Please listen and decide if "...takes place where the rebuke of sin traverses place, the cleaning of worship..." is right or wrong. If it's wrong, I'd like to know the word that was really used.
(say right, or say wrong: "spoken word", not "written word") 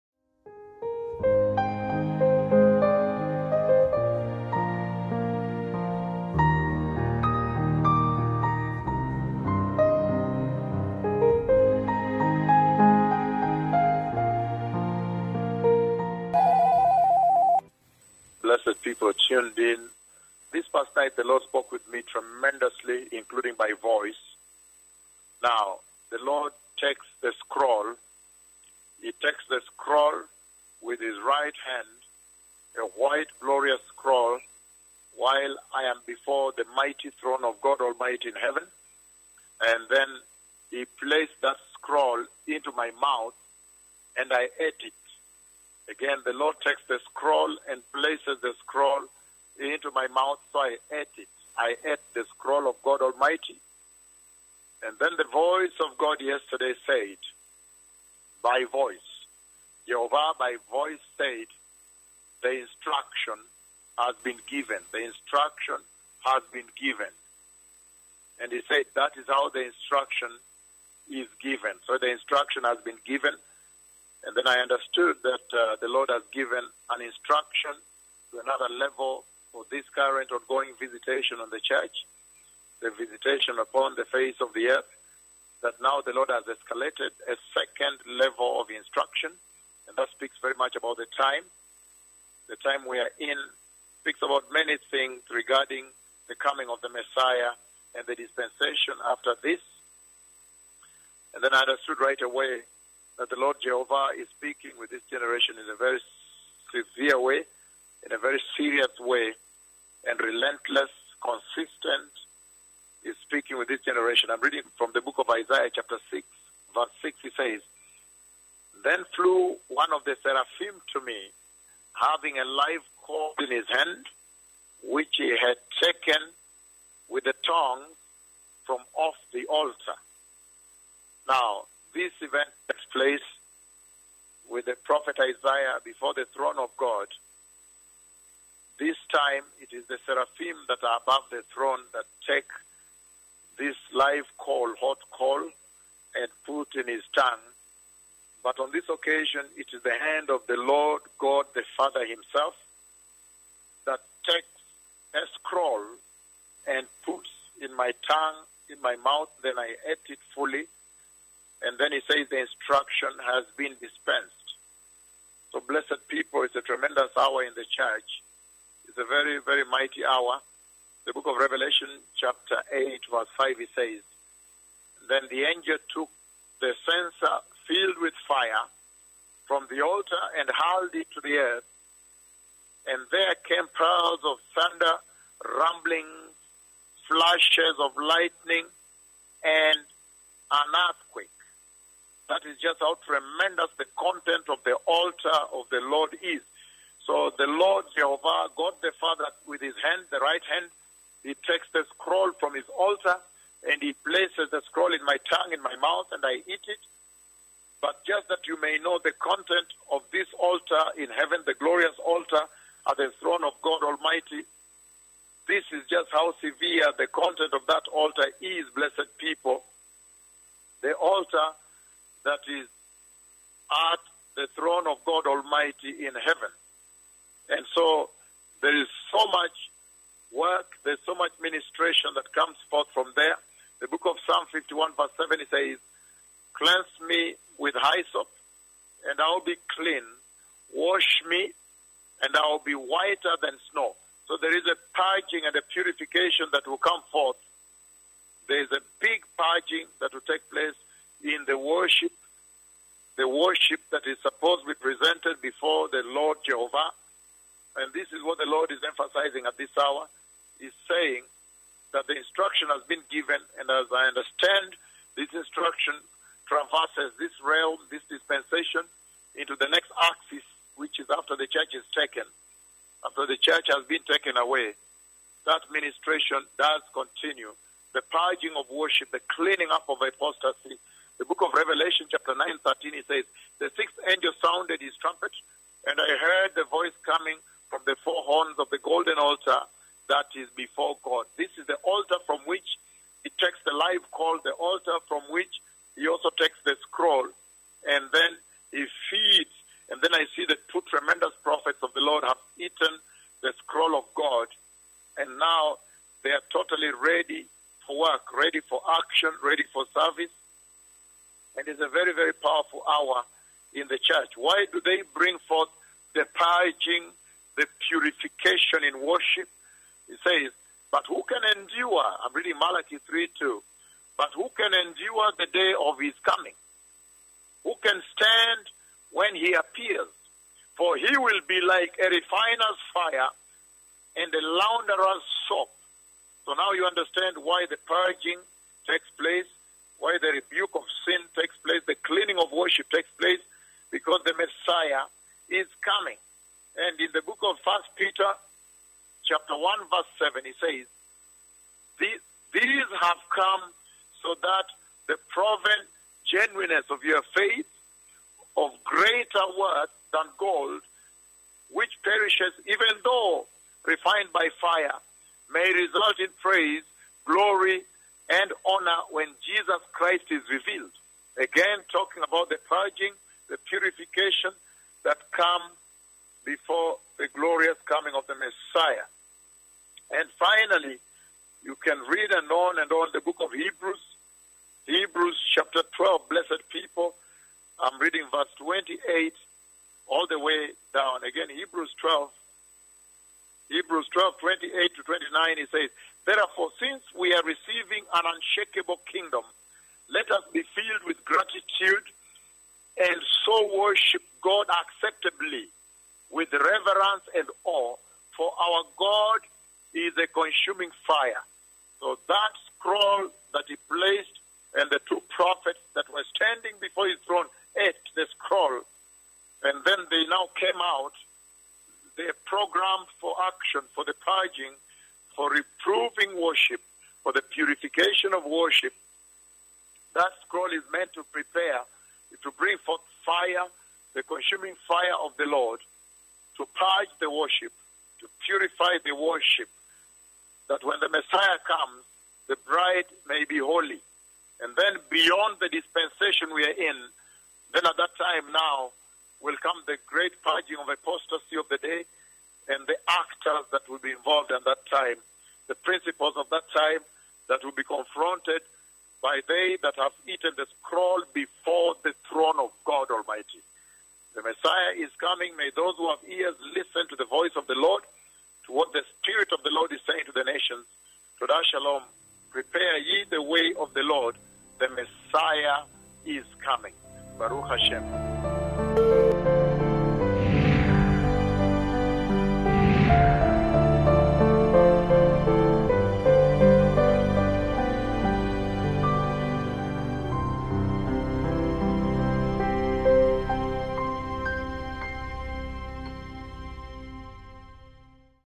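wrong: "takes", not "traverses".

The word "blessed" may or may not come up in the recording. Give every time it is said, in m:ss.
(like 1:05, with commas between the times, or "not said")
0:18, 2:45, 3:38, 6:26.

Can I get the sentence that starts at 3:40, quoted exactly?
The altar that is at the throne of God Almighty in heaven.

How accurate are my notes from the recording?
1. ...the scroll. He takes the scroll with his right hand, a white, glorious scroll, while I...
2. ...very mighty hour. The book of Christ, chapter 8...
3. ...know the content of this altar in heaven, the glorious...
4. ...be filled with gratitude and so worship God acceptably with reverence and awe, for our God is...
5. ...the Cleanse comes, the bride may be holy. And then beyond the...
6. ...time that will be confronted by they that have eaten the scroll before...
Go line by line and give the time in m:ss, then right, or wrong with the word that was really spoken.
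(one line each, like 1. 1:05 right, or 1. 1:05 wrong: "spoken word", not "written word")
1. 0:27 right
2. 2:49 wrong: "Revelation", not "Christ"
3. 3:28 right
4. 6:40 right
5. 7:20 wrong: "Messiah", not "Cleanse"
6. 7:36 right.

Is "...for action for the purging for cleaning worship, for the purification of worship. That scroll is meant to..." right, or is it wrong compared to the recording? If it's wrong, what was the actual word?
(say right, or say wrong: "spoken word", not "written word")
wrong: "reproving", not "cleaning".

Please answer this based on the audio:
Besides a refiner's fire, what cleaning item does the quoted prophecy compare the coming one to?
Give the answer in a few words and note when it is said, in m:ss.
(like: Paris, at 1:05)
launderer's soap, at 5:34.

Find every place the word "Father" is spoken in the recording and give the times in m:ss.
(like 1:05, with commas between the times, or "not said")
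2:31, 3:19.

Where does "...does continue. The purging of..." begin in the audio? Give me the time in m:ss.
4:36.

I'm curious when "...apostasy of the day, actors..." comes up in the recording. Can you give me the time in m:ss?
7:30.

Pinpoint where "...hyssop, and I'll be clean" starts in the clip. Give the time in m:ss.
3:57.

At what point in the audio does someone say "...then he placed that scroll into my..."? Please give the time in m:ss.
0:39.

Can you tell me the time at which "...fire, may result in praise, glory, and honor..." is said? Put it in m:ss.
6:04.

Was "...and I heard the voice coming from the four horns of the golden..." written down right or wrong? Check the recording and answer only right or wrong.
right.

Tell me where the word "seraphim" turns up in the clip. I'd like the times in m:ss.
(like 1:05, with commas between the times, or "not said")
2:00, 2:20.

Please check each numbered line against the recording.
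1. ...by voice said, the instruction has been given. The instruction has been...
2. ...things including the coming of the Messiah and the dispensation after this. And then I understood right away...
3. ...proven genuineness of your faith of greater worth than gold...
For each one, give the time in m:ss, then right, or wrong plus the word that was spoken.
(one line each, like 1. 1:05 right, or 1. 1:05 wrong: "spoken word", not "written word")
1. 1:00 right
2. 1:34 wrong: "regarding", not "including"
3. 5:55 right.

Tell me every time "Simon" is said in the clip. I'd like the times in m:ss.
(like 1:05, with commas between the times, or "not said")
not said.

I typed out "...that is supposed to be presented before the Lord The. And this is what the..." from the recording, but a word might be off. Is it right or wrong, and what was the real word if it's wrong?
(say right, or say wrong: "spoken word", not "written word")
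wrong: "Jehovah", not "The".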